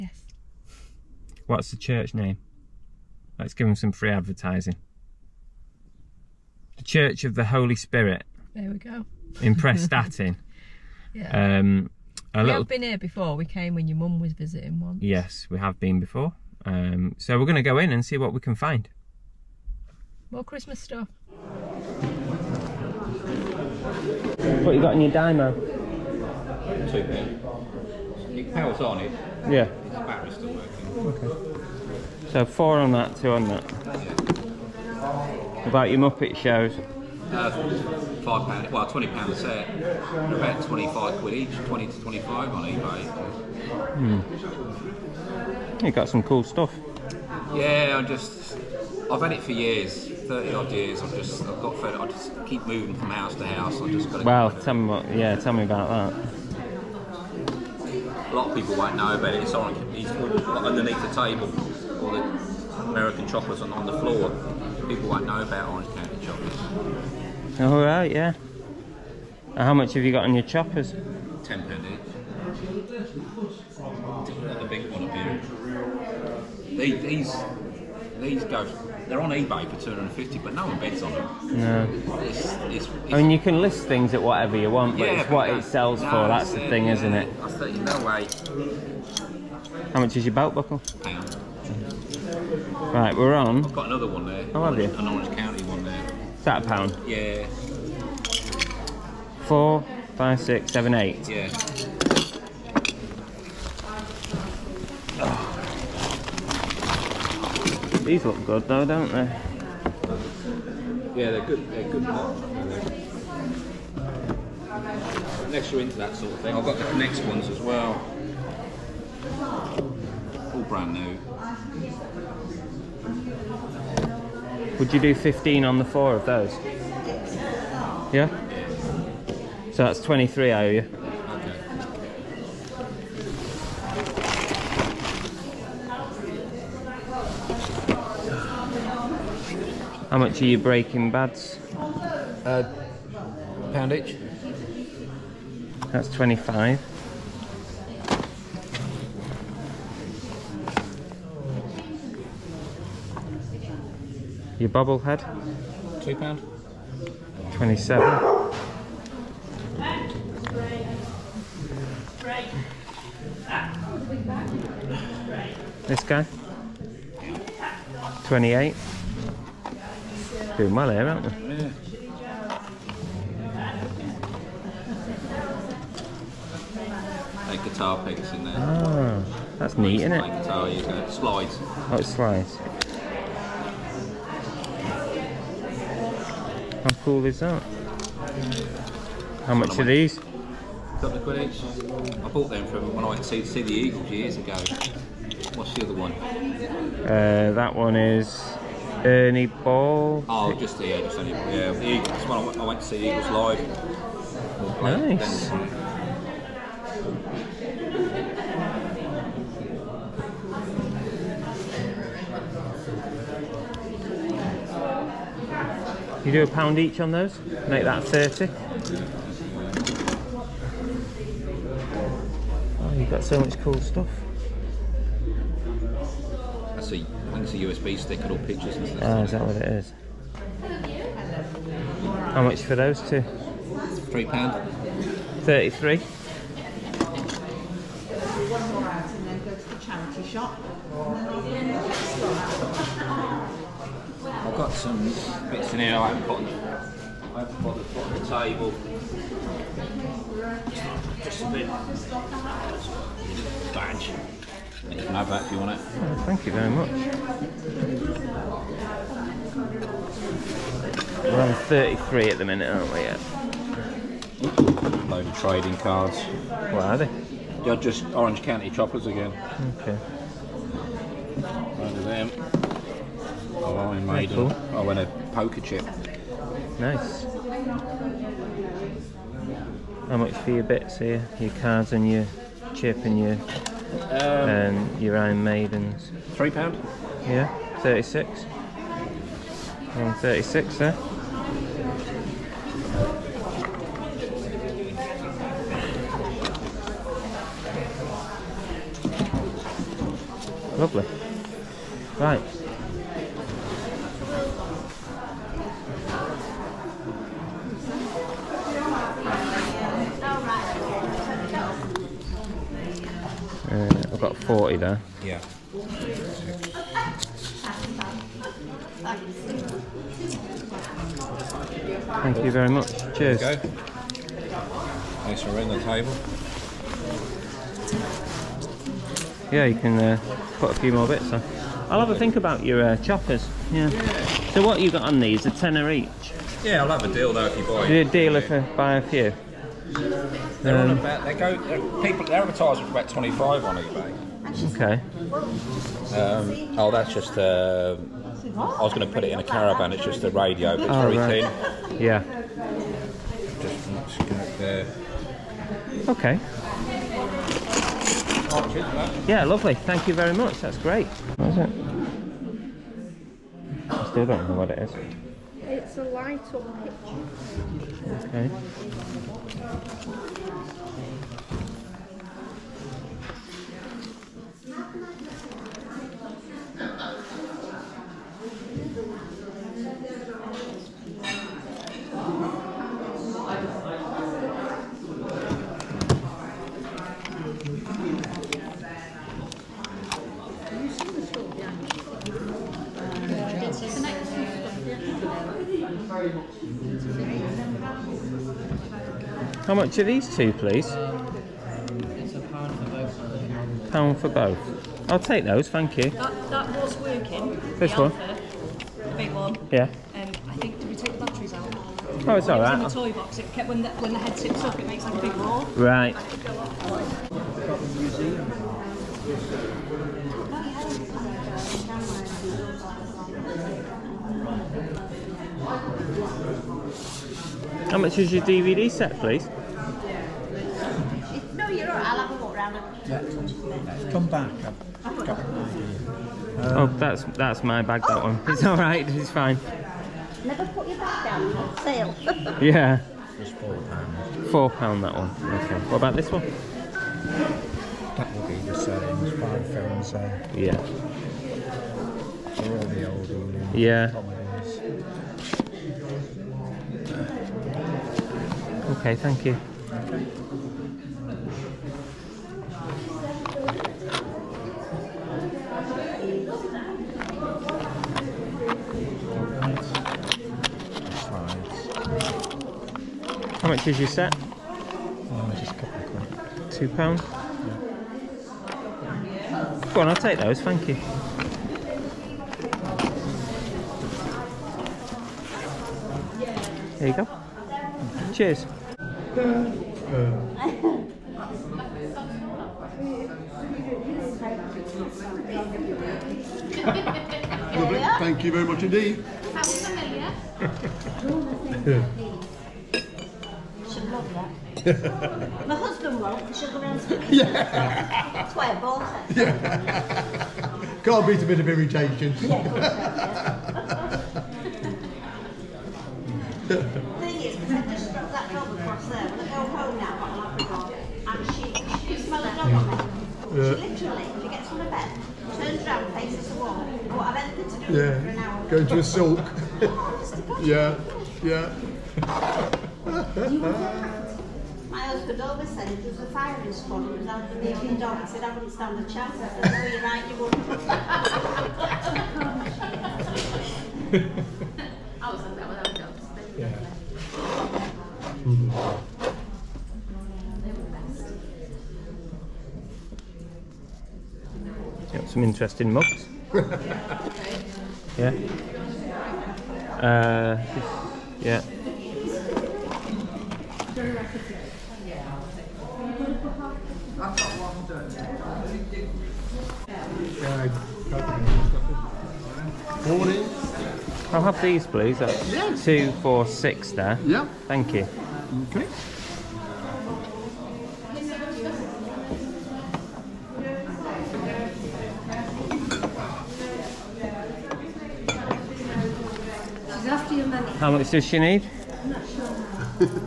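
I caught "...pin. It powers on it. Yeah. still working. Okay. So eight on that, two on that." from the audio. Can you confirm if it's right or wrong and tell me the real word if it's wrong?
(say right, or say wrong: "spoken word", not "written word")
wrong: "four", not "eight".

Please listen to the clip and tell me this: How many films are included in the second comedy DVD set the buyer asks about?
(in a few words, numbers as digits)
5.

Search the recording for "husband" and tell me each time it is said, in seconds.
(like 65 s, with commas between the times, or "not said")
505 s, 535 s.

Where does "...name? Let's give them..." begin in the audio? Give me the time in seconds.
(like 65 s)
2 s.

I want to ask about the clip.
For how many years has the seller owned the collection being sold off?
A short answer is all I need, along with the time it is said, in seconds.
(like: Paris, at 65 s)
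30 odd years, at 50 s.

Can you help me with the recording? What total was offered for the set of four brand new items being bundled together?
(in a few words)
15.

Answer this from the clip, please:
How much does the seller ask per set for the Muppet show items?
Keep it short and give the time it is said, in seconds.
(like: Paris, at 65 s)
£20, at 38 s.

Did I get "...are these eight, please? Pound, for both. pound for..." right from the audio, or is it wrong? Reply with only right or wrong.
wrong.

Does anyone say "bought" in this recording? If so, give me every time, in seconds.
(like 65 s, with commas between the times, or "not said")
192 s, 508 s.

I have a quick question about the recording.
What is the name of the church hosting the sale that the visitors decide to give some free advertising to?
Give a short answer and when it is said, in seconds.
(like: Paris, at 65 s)
The Church of the Holy Spirit, at 6 s.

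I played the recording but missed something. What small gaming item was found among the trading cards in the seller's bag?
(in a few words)
A poker chip.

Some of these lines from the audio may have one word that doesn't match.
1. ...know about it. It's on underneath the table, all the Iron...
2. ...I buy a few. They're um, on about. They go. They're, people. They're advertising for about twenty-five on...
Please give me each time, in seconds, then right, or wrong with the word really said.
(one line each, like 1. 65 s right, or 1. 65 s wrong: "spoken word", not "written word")
1. 58 s wrong: "American", not "Iron"
2. 338 s right.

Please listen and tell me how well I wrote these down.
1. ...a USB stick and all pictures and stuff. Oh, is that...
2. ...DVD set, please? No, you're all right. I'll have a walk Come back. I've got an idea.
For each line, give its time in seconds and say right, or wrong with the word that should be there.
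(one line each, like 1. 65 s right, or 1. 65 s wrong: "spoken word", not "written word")
1. 227 s right
2. 428 s right.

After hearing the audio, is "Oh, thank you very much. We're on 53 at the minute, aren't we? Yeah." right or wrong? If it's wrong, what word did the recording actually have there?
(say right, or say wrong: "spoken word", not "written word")
wrong: "33", not "53".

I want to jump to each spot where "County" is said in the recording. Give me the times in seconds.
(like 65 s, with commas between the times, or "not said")
65 s, 95 s, 268 s.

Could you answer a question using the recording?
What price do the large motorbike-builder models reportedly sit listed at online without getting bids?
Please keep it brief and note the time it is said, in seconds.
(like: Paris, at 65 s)
250, at 79 s.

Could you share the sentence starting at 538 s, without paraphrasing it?
He said, I wouldn't stand a chance.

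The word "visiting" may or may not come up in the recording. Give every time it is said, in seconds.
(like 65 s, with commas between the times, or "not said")
14 s.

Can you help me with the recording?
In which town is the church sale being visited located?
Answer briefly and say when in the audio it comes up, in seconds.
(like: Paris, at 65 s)
Prestatyn, at 9 s.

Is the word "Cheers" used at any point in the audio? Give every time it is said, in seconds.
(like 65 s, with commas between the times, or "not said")
323 s.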